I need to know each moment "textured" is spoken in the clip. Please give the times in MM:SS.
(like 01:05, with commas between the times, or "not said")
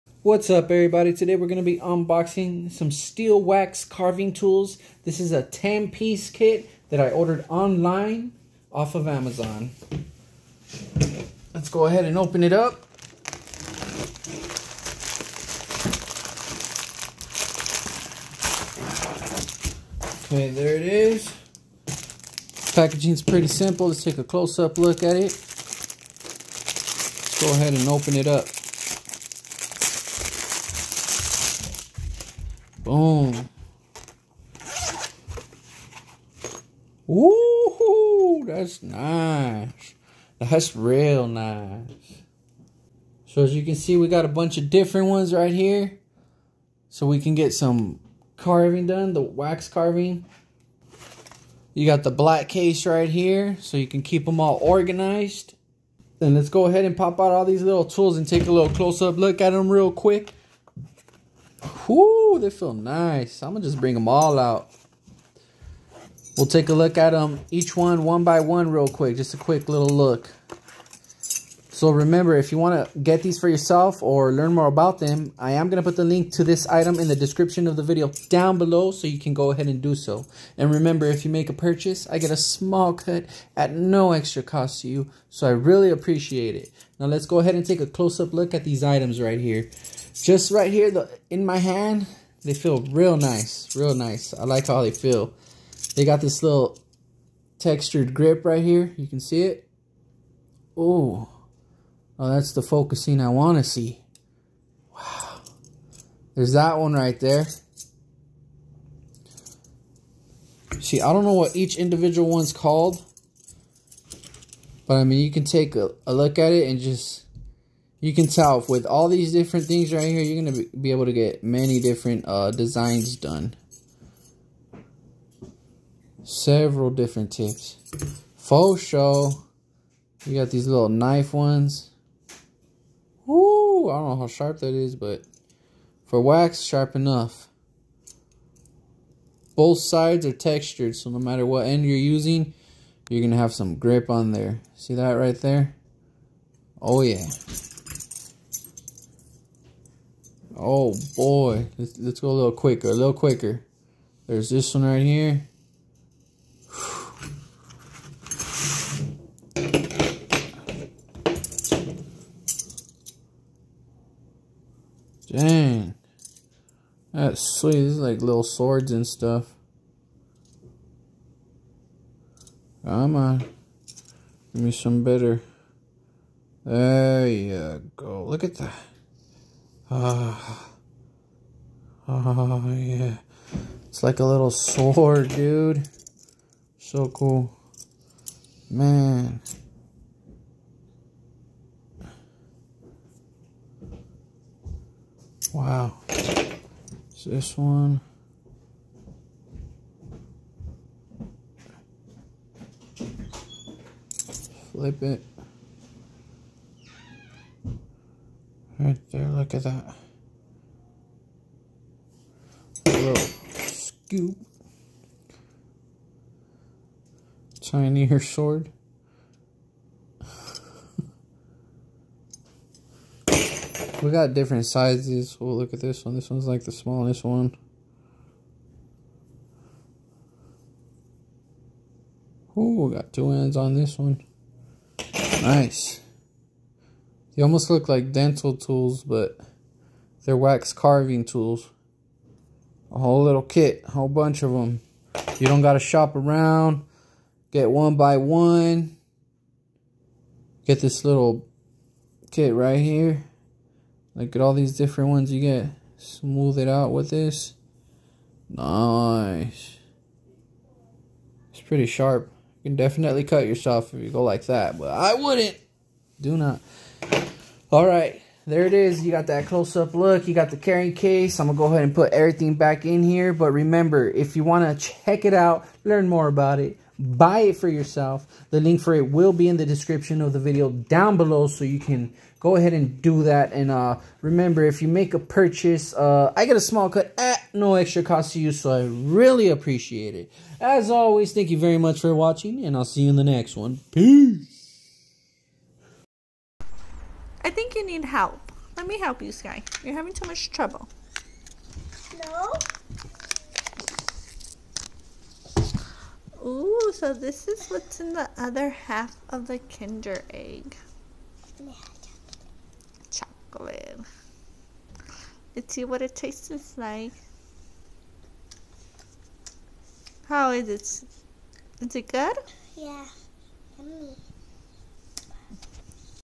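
01:37, 02:20.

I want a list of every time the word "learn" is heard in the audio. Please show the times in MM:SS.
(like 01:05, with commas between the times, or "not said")
01:14, 04:35.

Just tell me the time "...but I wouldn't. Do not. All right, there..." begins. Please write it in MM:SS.
04:24.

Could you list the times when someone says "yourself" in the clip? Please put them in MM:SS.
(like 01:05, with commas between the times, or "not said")
01:13, 04:23, 04:37.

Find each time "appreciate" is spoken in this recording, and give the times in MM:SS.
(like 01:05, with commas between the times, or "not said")
01:25, 04:49.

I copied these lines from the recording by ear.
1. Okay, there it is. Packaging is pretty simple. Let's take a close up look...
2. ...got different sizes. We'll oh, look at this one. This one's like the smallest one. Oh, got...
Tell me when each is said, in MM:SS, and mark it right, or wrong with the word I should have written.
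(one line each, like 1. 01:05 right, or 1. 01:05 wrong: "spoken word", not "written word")
1. 00:20 right
2. 03:44 right.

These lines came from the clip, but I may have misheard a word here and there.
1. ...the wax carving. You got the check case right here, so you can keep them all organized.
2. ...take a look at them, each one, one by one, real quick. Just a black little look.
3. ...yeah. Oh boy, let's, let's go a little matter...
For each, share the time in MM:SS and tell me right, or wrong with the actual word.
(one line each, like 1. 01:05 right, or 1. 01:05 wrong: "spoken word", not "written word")
1. 00:49 wrong: "black", not "check"
2. 01:06 wrong: "quick", not "black"
3. 02:27 wrong: "quicker", not "matter".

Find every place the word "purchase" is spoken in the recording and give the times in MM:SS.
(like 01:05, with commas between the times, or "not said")
01:21, 04:45.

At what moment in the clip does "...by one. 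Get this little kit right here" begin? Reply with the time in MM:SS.
04:07.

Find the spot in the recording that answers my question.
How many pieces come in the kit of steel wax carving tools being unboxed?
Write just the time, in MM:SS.
00:05.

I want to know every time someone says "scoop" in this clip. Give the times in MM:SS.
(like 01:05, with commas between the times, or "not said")
03:33.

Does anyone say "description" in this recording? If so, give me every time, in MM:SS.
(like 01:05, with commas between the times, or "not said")
01:17, 04:39.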